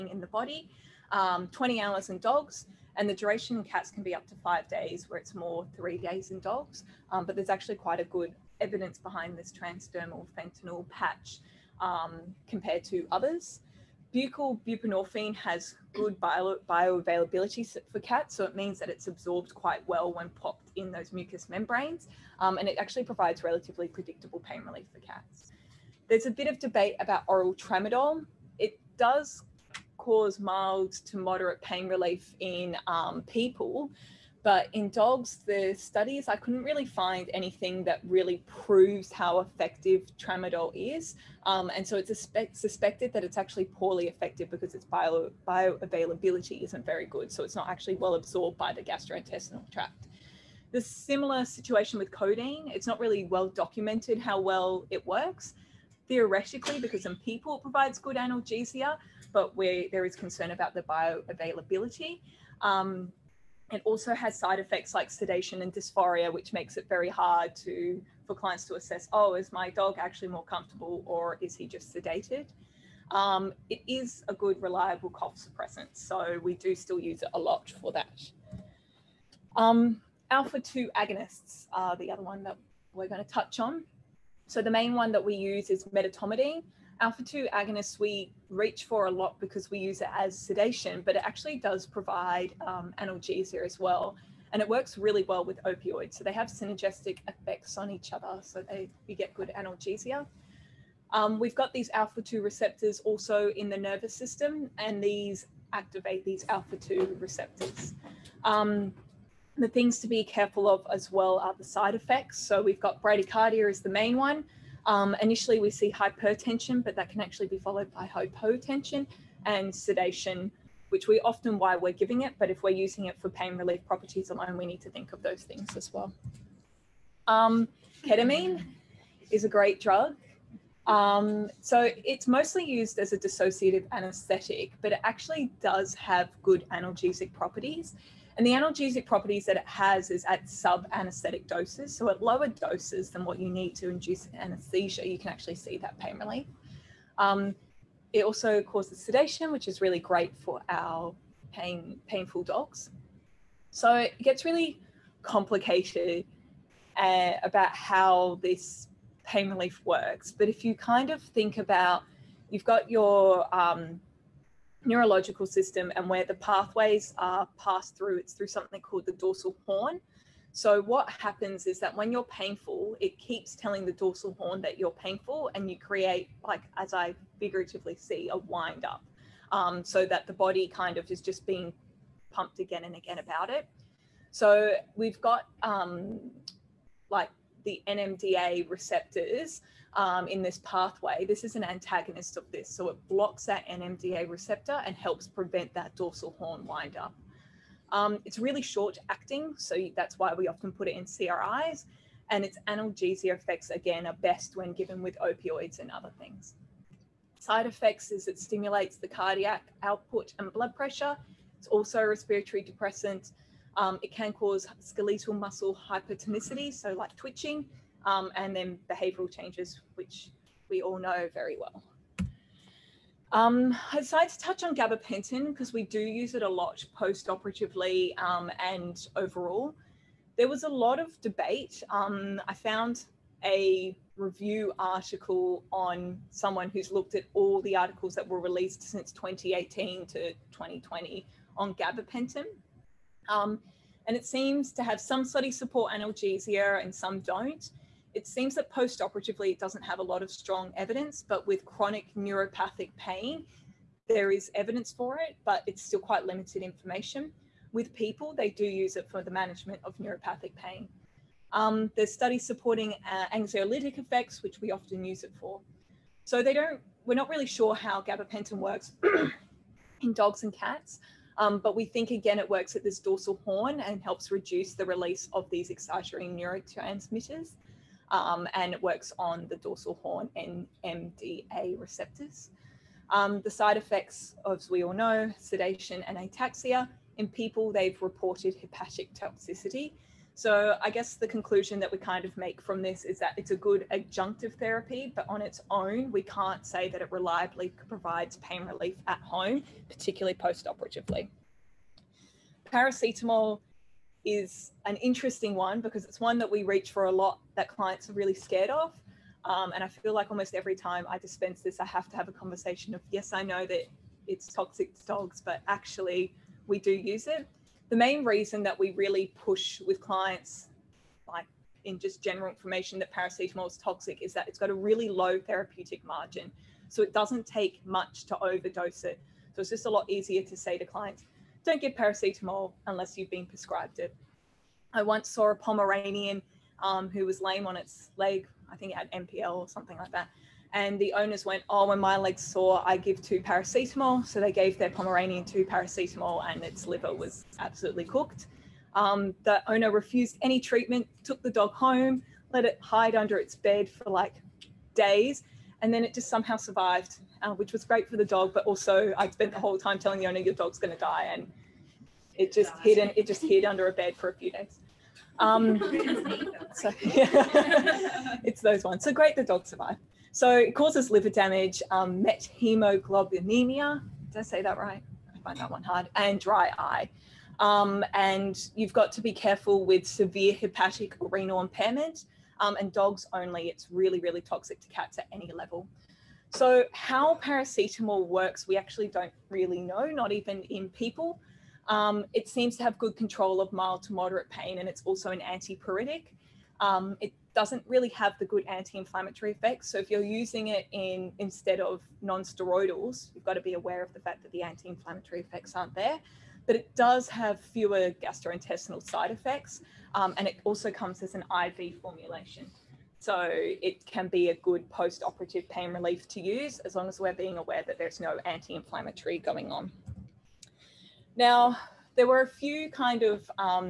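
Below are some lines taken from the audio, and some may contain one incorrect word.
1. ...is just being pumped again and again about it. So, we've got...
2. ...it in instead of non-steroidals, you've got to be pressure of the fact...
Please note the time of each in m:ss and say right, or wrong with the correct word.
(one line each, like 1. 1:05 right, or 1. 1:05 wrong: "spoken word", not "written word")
1. 3:01 right
2. 6:40 wrong: "aware", not "pressure".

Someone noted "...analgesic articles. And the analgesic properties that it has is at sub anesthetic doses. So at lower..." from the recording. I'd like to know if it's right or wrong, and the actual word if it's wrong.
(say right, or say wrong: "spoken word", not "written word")
wrong: "properties", not "articles".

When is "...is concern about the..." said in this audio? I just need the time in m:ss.
1:00.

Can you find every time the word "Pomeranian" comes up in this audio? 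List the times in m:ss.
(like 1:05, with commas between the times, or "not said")
5:35, 5:44.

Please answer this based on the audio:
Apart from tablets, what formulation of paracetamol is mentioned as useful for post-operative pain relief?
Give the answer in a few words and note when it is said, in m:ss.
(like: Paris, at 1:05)
IV formulation, at 6:51.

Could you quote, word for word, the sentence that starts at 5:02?
Paracetamol is an interesting one because it's one that we reach for a lot that clients are really scared of.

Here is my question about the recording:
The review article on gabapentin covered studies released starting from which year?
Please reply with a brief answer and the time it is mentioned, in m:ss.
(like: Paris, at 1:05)
2018, at 3:59.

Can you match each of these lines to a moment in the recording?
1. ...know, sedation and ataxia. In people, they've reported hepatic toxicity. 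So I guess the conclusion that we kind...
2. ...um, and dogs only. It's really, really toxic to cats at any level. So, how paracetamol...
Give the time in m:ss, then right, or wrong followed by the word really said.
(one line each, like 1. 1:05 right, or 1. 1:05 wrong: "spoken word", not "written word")
1. 4:44 right
2. 6:22 right.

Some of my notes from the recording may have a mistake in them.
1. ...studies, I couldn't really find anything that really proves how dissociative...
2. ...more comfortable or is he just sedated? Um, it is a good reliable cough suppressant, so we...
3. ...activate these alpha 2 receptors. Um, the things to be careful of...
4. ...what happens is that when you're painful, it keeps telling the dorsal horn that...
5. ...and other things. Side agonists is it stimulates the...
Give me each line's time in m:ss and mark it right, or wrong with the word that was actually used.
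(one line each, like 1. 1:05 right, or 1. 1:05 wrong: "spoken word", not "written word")
1. 0:35 wrong: "effective", not "dissociative"
2. 1:10 right
3. 1:45 right
4. 2:50 right
5. 3:25 wrong: "effects", not "agonists".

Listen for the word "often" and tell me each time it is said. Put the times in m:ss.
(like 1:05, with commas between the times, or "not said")
2:01, 3:20, 4:24.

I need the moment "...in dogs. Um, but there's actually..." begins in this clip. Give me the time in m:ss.
0:06.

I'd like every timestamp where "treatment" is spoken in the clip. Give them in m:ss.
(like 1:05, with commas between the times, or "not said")
5:50.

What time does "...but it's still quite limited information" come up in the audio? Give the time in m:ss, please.
4:15.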